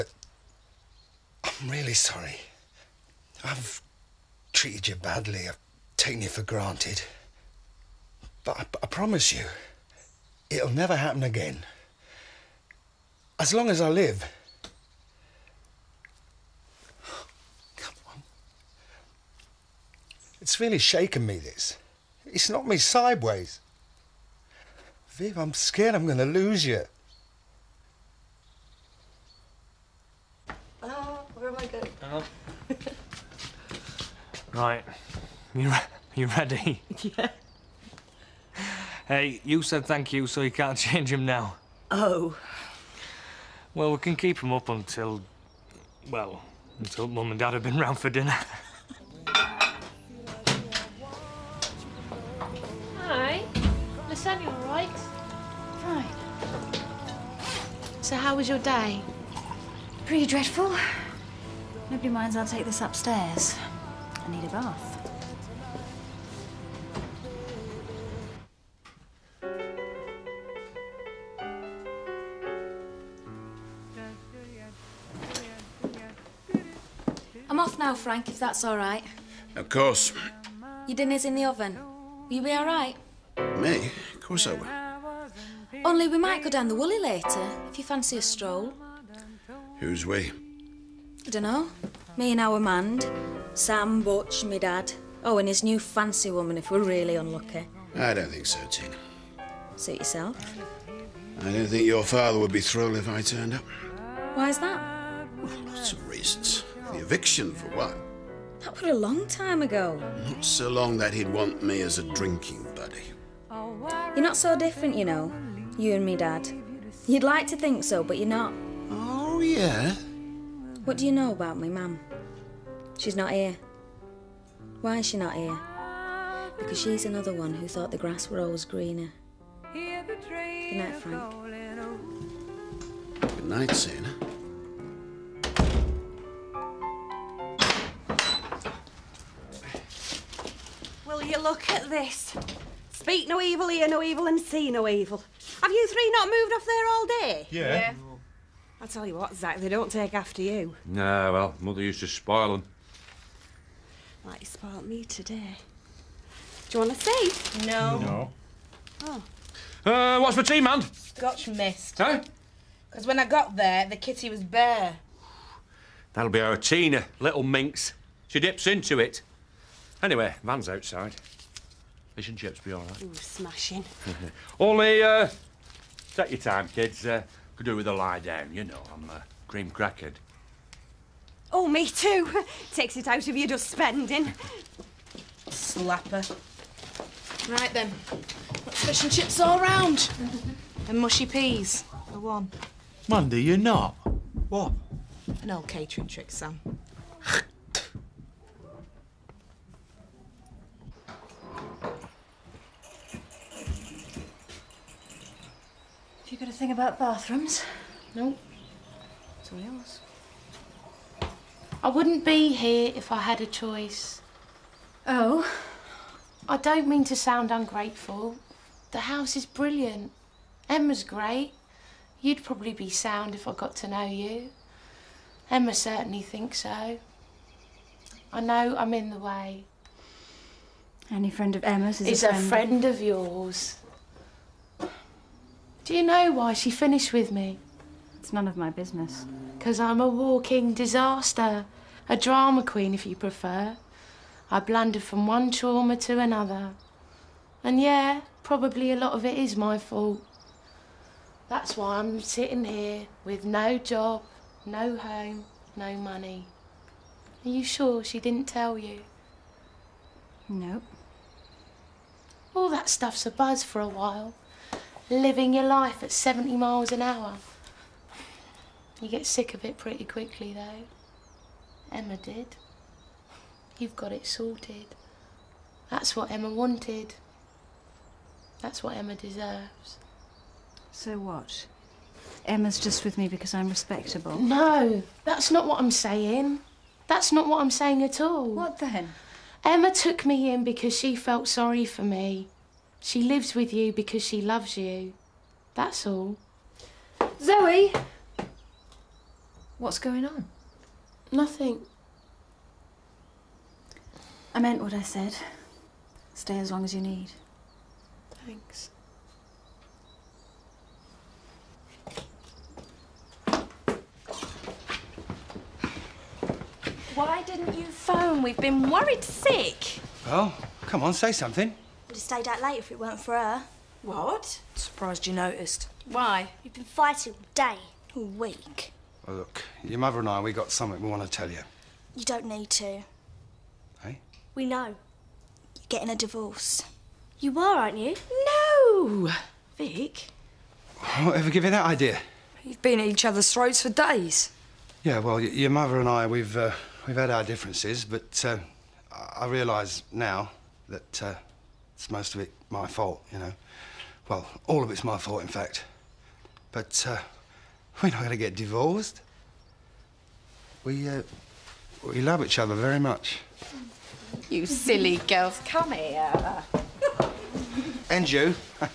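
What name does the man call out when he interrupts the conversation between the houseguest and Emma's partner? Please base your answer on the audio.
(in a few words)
Zoe.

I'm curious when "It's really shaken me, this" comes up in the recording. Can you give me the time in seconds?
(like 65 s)
20 s.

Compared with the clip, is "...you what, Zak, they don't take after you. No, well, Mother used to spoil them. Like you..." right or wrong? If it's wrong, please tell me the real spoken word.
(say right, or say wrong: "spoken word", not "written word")
right.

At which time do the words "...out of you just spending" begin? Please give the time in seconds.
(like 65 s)
183 s.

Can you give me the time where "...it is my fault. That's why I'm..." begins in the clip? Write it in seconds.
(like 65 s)
249 s.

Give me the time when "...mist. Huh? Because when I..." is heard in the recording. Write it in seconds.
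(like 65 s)
161 s.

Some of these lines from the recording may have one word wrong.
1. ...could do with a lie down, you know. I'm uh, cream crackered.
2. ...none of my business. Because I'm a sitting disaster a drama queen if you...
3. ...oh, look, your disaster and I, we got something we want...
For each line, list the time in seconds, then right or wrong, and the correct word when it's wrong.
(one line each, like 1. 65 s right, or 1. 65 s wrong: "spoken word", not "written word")
1. 177 s right
2. 238 s wrong: "walking", not "sitting"
3. 329 s wrong: "mother", not "disaster".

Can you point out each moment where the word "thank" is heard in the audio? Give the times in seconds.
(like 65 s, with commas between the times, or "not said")
39 s, 308 s.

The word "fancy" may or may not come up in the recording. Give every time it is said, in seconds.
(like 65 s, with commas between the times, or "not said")
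87 s, 95 s.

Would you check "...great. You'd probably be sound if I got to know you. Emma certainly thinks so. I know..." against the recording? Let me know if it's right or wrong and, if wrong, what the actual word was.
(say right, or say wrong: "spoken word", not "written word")
right.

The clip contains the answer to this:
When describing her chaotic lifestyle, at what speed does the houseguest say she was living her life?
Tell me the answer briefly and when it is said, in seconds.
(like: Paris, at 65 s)
70 miles an hour, at 266 s.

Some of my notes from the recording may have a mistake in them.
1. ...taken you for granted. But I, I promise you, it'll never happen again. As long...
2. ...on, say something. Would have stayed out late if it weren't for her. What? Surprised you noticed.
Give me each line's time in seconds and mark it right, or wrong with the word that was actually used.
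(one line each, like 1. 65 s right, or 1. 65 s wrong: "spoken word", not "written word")
1. 5 s right
2. 321 s right.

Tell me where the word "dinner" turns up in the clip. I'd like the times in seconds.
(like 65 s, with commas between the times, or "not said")
48 s, 80 s.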